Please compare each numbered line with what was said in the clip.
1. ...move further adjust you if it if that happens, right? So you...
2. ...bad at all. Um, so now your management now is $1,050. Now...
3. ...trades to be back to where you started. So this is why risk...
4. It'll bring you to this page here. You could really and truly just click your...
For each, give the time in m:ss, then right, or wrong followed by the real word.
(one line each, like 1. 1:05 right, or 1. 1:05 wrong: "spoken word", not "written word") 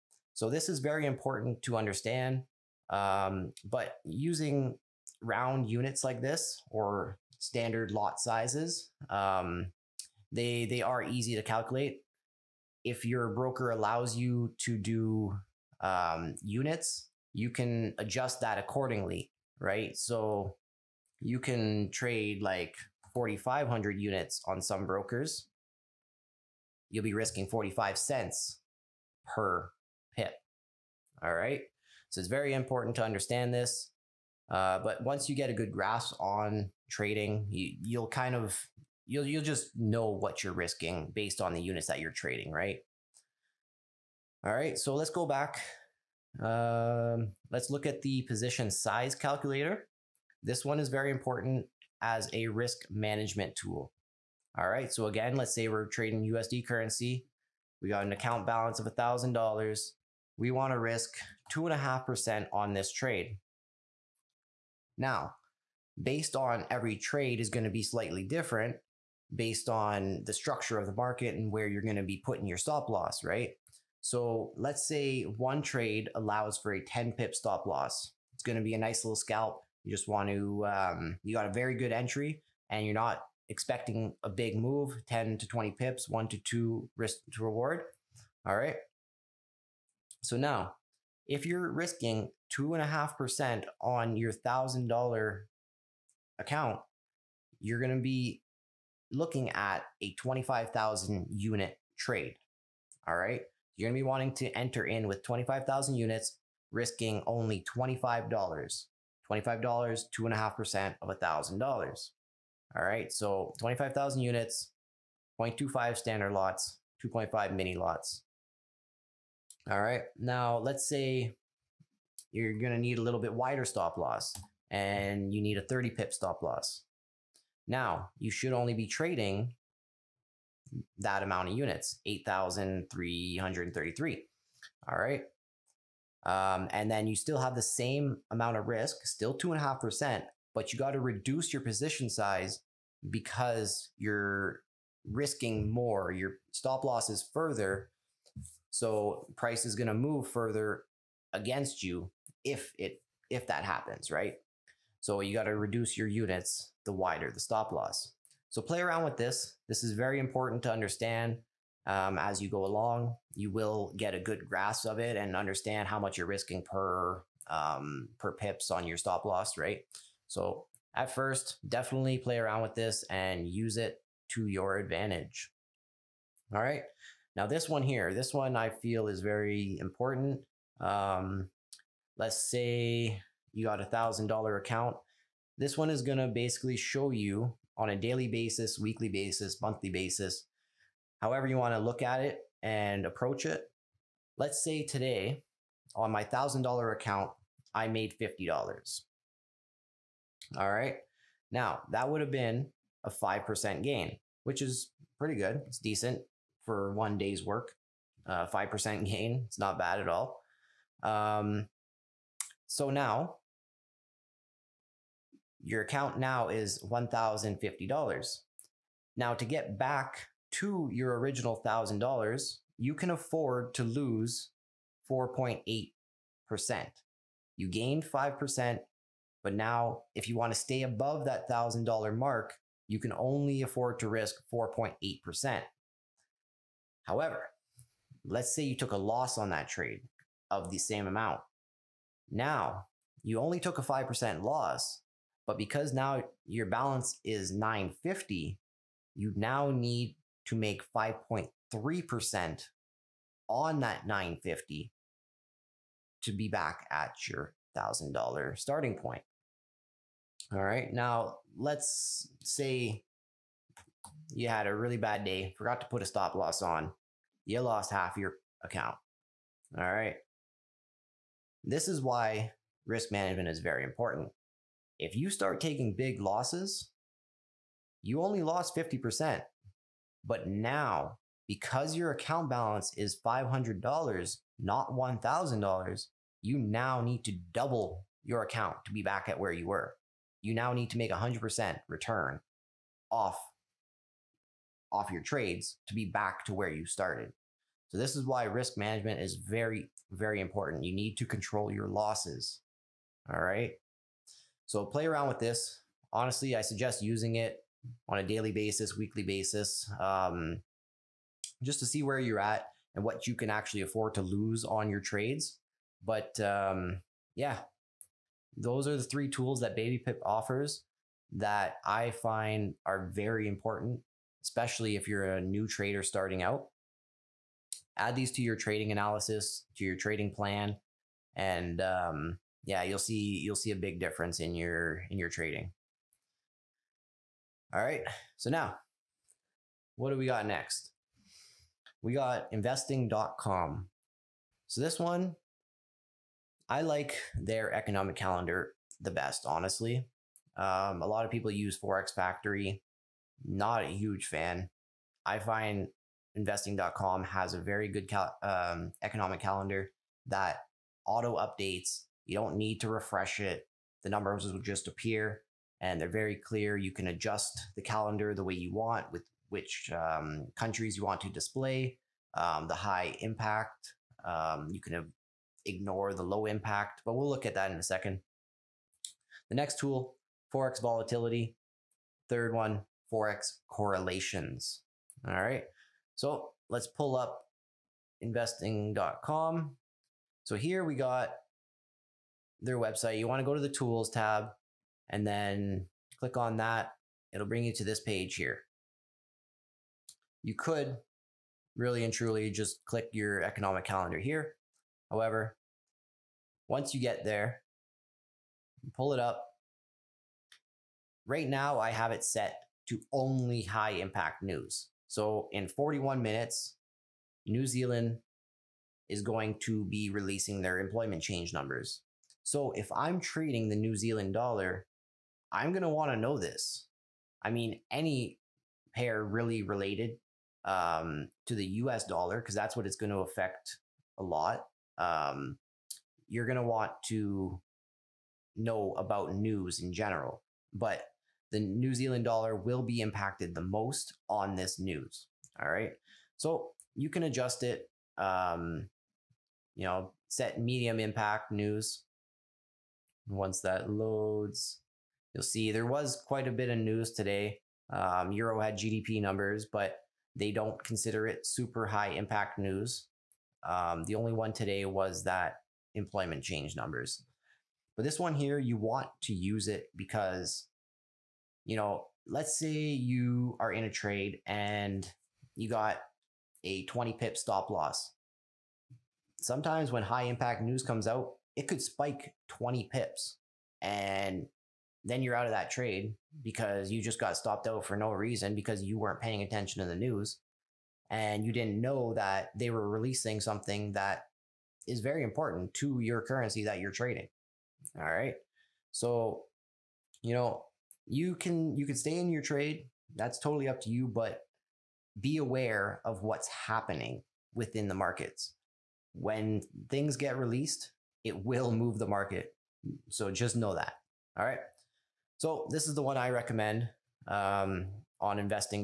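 1. 2:29 wrong: "against", not "adjust"
2. 3:29 wrong: "account", not "management"
3. 4:55 right
4. 6:37 right.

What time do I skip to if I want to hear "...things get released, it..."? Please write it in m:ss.
8:29.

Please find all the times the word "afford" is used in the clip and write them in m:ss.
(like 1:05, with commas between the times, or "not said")
3:43, 3:53, 5:13.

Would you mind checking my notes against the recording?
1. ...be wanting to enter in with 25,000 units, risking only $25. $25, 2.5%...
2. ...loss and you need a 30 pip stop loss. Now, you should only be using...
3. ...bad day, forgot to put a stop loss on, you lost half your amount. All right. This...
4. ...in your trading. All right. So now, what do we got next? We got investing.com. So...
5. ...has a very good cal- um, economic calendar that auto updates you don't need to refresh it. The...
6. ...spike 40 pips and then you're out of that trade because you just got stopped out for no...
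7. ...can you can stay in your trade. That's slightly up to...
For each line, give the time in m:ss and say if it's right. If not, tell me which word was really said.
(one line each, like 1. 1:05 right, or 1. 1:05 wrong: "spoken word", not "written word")
1. 1:44 right
2. 2:03 wrong: "trading", not "using"
3. 4:24 wrong: "account", not "amount"
4. 5:35 right
5. 5:57 right
6. 8:01 wrong: "20", not "40"
7. 8:21 wrong: "totally", not "slightly".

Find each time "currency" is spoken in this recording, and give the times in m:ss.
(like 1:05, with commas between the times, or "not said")
0:56, 8:16.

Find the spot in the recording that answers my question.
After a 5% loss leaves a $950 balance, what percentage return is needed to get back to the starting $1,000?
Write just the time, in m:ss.
4:10.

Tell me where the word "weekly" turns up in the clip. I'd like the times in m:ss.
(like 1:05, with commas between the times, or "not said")
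3:08, 5:08.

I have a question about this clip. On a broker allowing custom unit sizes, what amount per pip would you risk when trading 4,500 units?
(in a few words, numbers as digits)
45 cents.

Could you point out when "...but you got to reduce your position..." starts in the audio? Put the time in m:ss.
2:20.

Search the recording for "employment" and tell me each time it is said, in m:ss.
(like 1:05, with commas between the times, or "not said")
7:00, 7:45.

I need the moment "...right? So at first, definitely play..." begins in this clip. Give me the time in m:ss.
2:49.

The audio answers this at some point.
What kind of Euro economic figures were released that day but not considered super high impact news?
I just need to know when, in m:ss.
7:38.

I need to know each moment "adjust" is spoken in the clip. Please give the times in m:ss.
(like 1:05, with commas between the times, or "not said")
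0:17, 6:07, 7:27.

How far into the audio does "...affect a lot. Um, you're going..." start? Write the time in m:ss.
7:13.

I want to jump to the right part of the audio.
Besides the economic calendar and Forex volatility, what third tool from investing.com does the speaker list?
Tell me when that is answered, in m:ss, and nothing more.
6:23.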